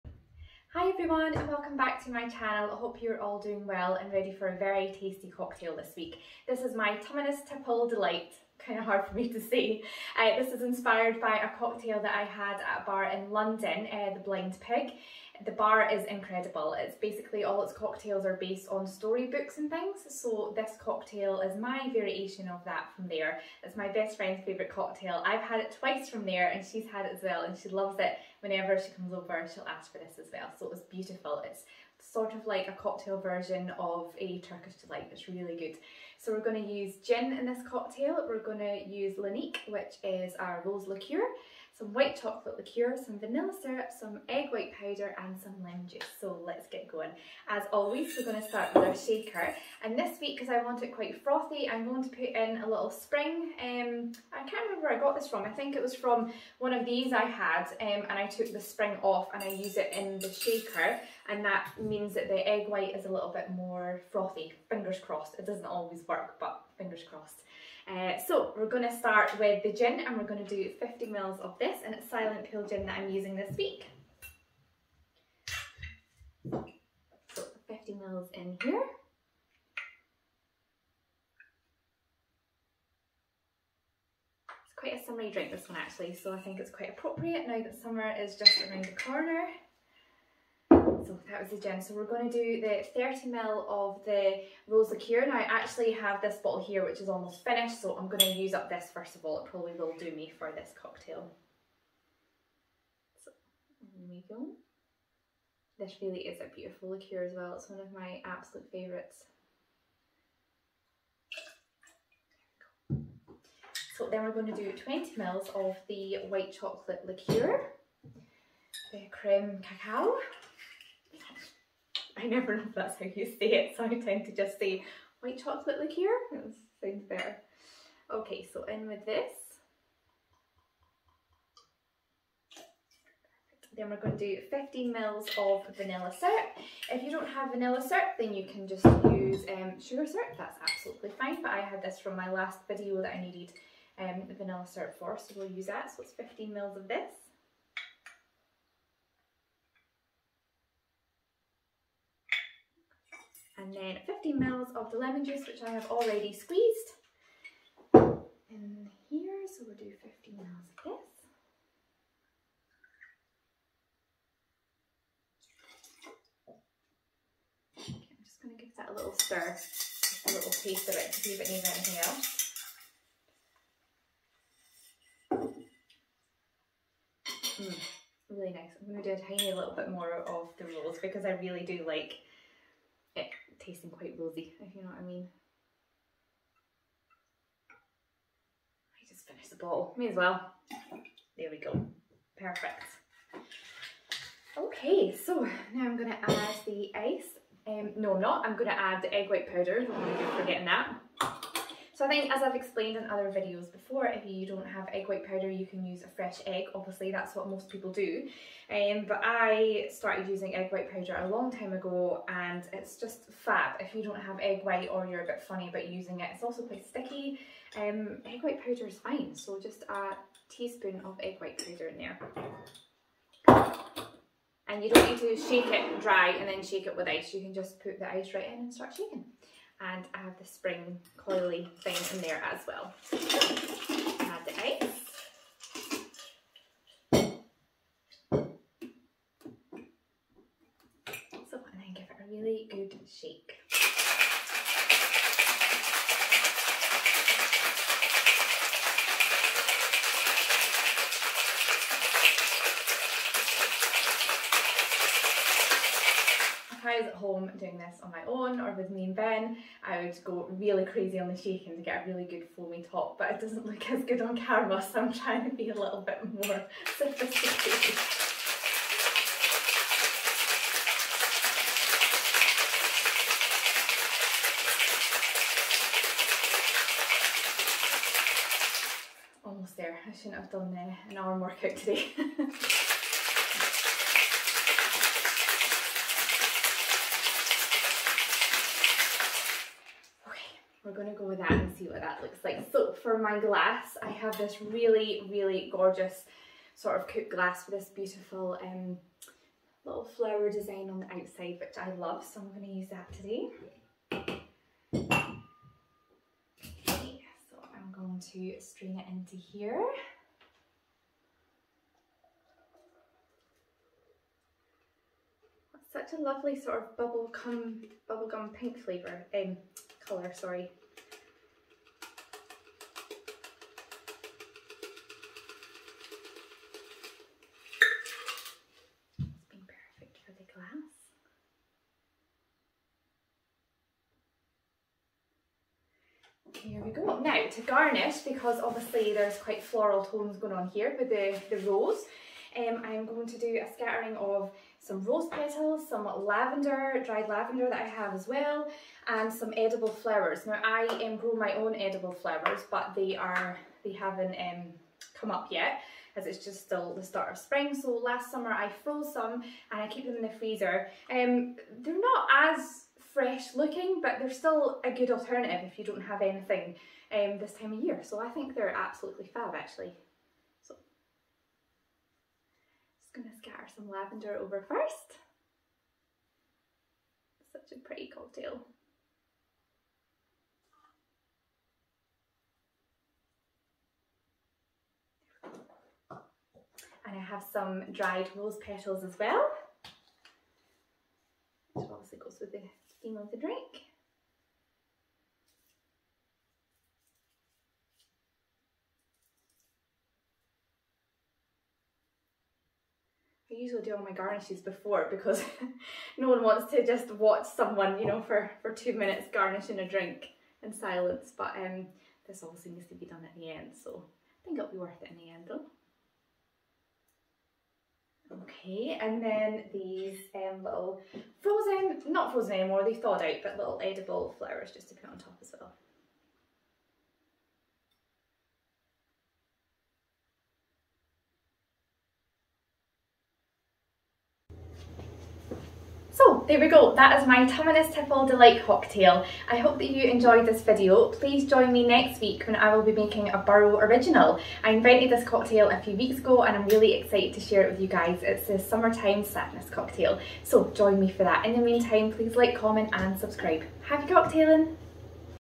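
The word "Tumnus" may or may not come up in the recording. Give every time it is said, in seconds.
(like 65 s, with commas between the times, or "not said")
6 s, 437 s.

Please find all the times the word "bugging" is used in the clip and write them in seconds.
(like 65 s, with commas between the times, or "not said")
not said.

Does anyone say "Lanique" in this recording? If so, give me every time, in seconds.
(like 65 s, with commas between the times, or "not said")
39 s.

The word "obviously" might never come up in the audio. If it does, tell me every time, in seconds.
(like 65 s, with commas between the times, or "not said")
206 s, 338 s, 391 s.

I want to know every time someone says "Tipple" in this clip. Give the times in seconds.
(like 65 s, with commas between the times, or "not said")
7 s, 437 s.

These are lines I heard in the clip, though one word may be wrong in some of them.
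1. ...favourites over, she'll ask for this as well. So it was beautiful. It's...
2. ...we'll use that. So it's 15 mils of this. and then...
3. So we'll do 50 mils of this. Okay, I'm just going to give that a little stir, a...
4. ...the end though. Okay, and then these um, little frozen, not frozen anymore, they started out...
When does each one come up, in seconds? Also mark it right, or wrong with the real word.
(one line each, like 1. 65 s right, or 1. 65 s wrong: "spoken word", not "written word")
1. 28 s wrong: "comes", not "favourites"
2. 145 s right
3. 159 s right
4. 415 s wrong: "thawed", not "started".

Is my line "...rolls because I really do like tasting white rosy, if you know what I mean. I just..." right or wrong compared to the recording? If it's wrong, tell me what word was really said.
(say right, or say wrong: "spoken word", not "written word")
wrong: "quite", not "white".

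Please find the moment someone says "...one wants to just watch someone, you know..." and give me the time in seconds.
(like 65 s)
406 s.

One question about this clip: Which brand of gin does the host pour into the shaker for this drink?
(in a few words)
Silent Pool.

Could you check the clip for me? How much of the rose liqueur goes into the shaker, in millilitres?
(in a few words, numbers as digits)
30 ml.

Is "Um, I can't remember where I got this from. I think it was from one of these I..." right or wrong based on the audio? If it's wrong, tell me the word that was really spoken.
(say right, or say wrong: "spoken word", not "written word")
right.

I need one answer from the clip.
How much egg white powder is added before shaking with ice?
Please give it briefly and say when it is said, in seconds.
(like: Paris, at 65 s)
A teaspoon, at 219 s.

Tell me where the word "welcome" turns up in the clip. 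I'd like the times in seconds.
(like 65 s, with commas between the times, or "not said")
1 s.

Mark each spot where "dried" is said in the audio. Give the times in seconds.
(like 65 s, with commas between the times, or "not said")
347 s, 387 s.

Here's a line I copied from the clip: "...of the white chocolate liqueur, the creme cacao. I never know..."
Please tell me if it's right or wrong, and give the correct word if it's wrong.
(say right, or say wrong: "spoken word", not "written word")
right.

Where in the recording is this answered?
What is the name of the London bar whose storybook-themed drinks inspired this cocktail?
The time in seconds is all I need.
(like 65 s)
14 s.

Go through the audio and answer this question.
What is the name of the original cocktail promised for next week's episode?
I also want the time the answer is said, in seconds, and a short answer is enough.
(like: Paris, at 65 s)
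Summertime Sadness, at 448 s.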